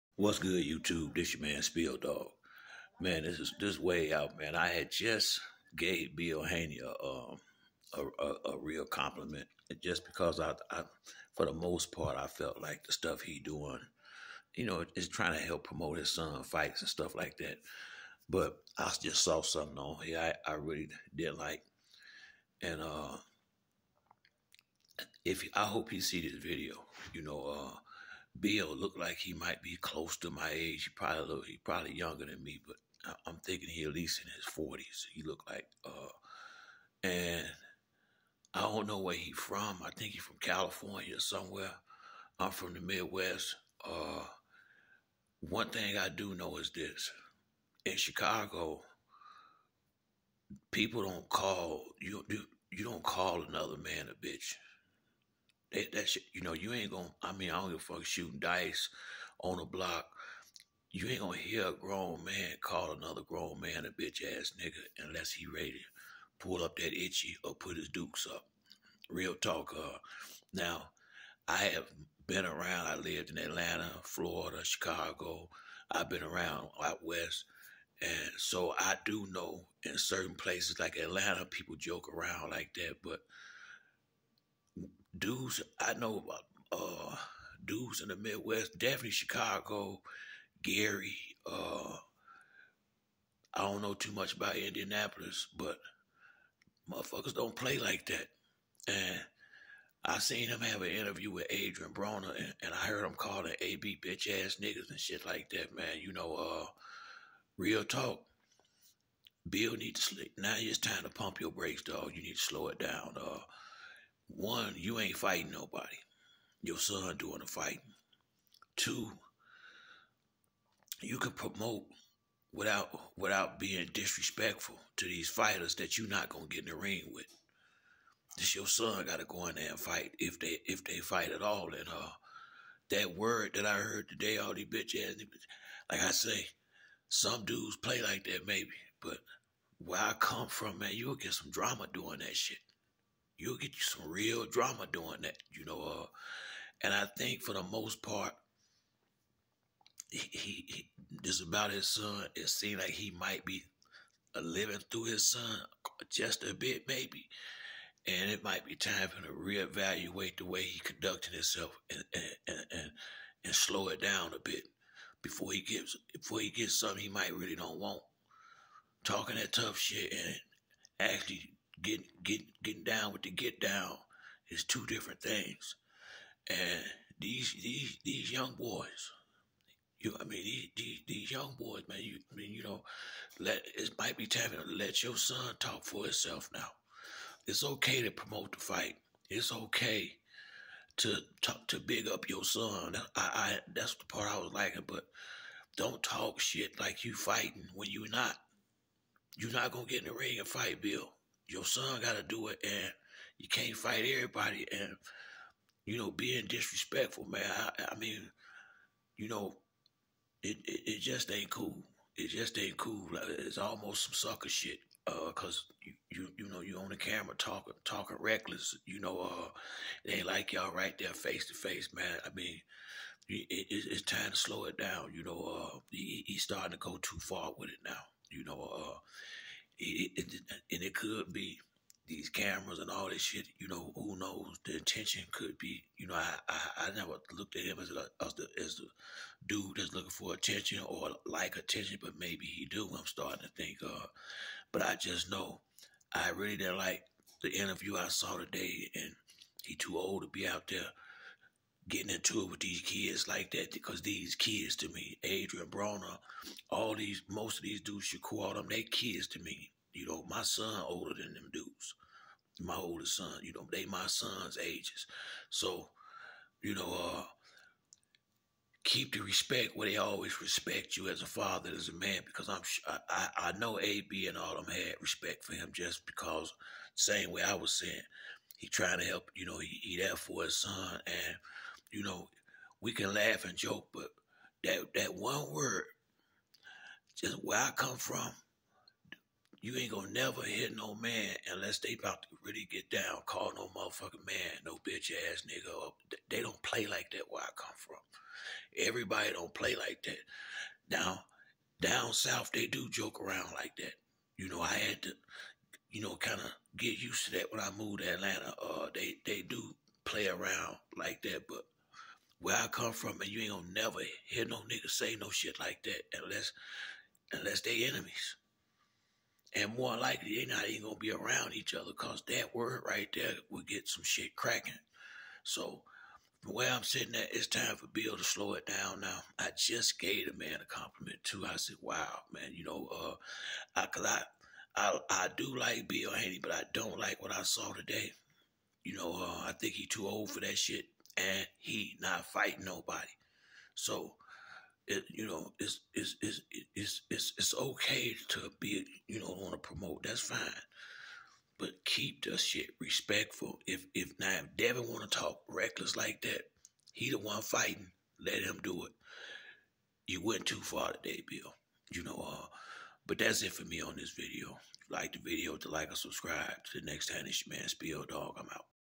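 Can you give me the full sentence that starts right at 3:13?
I, I that's the part I was liking, but don't talk shit like you fighting when you're not.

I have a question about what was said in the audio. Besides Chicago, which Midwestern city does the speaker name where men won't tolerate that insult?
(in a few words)
Gary.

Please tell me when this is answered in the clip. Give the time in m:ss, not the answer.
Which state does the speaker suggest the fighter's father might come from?
0:40.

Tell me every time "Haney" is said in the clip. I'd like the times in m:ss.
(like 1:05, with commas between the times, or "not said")
0:06, 5:36.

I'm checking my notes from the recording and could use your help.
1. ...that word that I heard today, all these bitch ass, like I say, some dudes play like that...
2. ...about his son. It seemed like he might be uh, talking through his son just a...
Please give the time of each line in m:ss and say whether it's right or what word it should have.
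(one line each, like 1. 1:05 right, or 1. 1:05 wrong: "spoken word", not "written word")
1. 2:12 right
2. 2:31 wrong: "living", not "talking".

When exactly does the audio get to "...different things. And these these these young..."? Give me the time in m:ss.
2:54.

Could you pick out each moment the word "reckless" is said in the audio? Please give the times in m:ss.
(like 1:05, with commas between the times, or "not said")
3:38, 5:55.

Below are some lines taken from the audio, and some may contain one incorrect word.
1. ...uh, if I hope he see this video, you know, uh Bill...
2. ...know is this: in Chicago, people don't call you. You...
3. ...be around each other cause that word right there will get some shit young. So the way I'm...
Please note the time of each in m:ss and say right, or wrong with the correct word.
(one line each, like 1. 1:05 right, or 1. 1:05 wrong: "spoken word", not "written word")
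1. 0:22 right
2. 0:46 right
3. 5:20 wrong: "cracking", not "young".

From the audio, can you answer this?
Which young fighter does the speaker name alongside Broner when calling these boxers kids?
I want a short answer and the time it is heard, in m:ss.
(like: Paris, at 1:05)
Shakur, at 4:18.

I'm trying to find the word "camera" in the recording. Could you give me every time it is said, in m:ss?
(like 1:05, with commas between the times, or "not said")
3:36, 3:52.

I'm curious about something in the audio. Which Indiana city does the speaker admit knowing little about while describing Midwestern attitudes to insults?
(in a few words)
Indianapolis.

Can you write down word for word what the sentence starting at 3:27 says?
I, I mean, you know, it, it, it just ain't cool.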